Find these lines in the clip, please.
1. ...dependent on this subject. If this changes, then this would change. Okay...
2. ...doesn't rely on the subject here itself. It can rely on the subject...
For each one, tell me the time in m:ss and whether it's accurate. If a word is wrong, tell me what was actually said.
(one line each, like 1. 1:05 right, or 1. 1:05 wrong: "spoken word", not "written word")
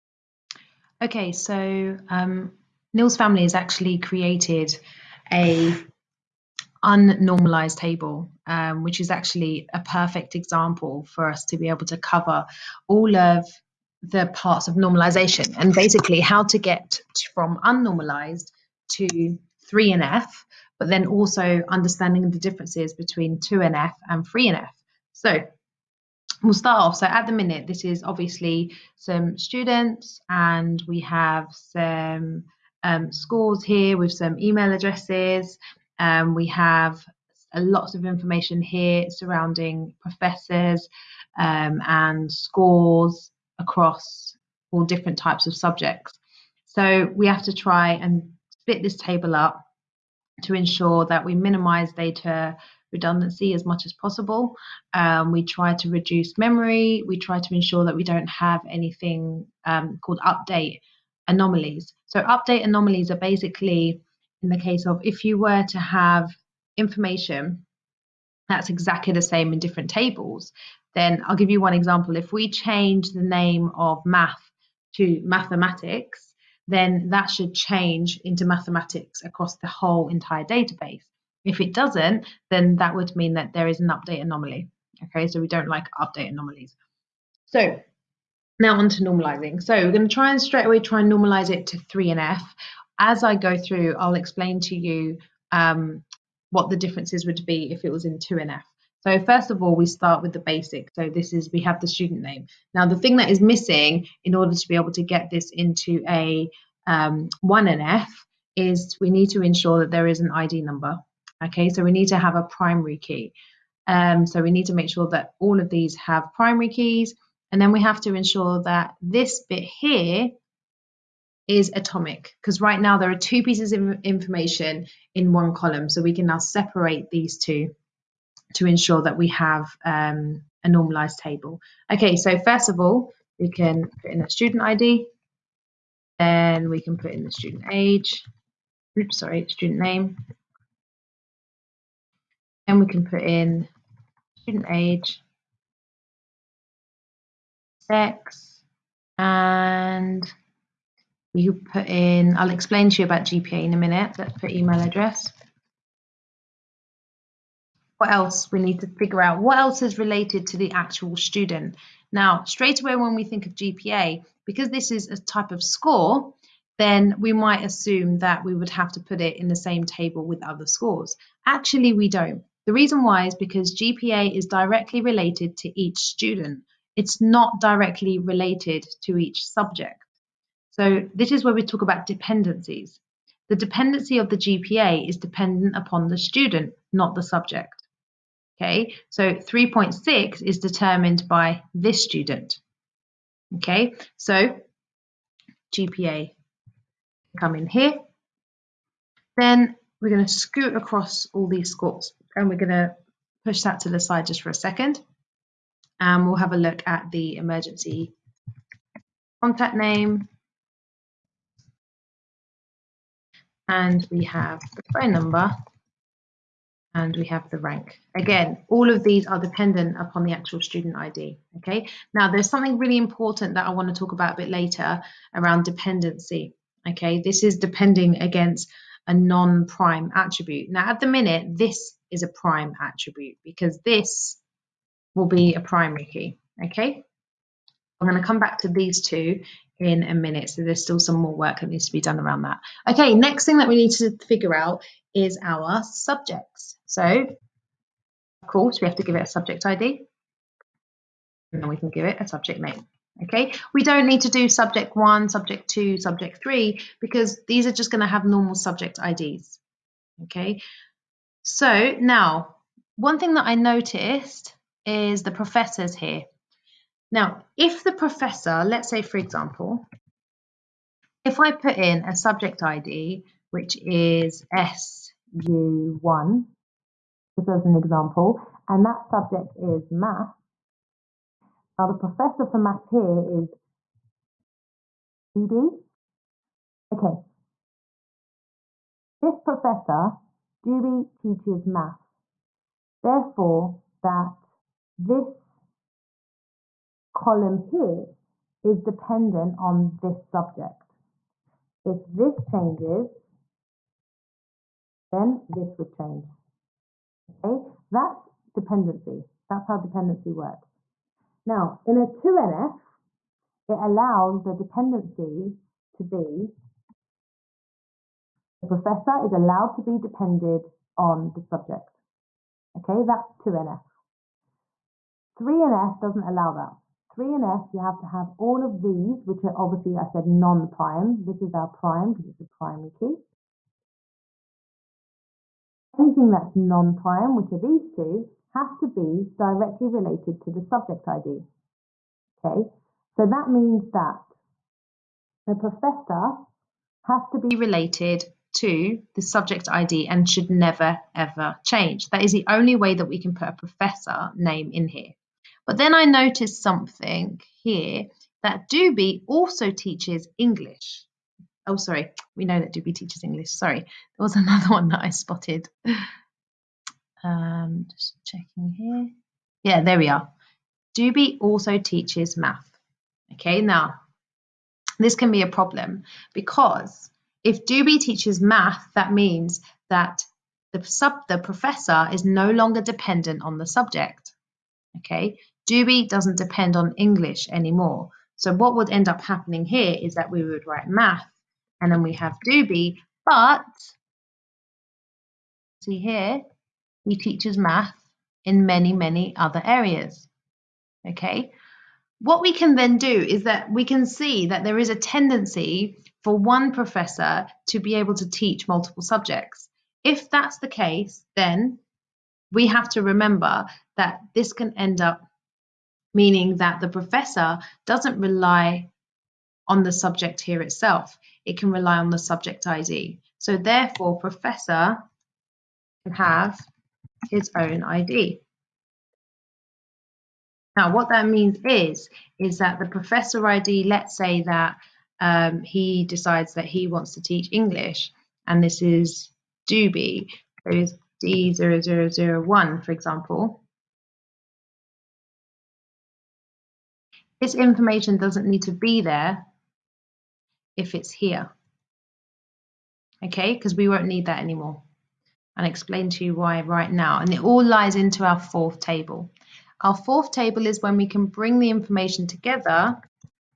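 1. 4:58 right
2. 6:57 right.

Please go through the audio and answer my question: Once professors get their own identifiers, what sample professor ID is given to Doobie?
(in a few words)
D0001.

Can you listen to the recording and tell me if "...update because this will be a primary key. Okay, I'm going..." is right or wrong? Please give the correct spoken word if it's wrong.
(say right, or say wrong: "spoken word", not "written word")
wrong: "attribute", not "update".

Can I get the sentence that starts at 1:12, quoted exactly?
If we change the name of math to mathematics, then that should change into mathematics across the whole entire database.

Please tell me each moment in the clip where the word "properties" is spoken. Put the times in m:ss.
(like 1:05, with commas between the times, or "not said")
not said.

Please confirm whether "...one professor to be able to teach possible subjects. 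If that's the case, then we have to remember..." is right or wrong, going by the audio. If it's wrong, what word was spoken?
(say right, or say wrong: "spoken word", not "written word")
wrong: "multiple", not "possible".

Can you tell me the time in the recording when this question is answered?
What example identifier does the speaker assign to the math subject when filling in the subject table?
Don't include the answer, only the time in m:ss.
4:34.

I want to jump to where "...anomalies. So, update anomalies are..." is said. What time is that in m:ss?
1:01.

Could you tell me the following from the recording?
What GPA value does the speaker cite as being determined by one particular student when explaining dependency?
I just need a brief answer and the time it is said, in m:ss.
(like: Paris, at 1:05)
3.6, at 3:09.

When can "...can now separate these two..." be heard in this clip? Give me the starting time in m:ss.
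2:06.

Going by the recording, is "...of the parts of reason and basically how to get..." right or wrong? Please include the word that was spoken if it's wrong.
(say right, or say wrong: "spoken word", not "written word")
wrong: "normalization", not "reason".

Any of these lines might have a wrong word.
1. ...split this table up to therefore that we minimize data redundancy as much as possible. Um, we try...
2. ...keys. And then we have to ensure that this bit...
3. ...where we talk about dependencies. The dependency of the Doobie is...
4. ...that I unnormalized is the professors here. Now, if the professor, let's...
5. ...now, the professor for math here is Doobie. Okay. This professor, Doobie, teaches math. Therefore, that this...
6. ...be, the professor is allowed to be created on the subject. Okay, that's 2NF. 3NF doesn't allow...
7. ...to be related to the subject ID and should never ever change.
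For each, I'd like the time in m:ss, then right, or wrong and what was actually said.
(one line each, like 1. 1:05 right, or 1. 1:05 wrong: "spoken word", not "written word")
1. 0:48 wrong: "ensure", not "therefore"
2. 1:56 right
3. 3:01 wrong: "GPA", not "Doobie"
4. 4:23 wrong: "noticed", not "unnormalized"
5. 4:41 right
6. 5:16 wrong: "depended", not "created"
7. 5:47 right.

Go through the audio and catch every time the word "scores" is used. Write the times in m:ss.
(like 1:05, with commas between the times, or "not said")
0:33, 0:42, 2:45, 2:50, 3:21.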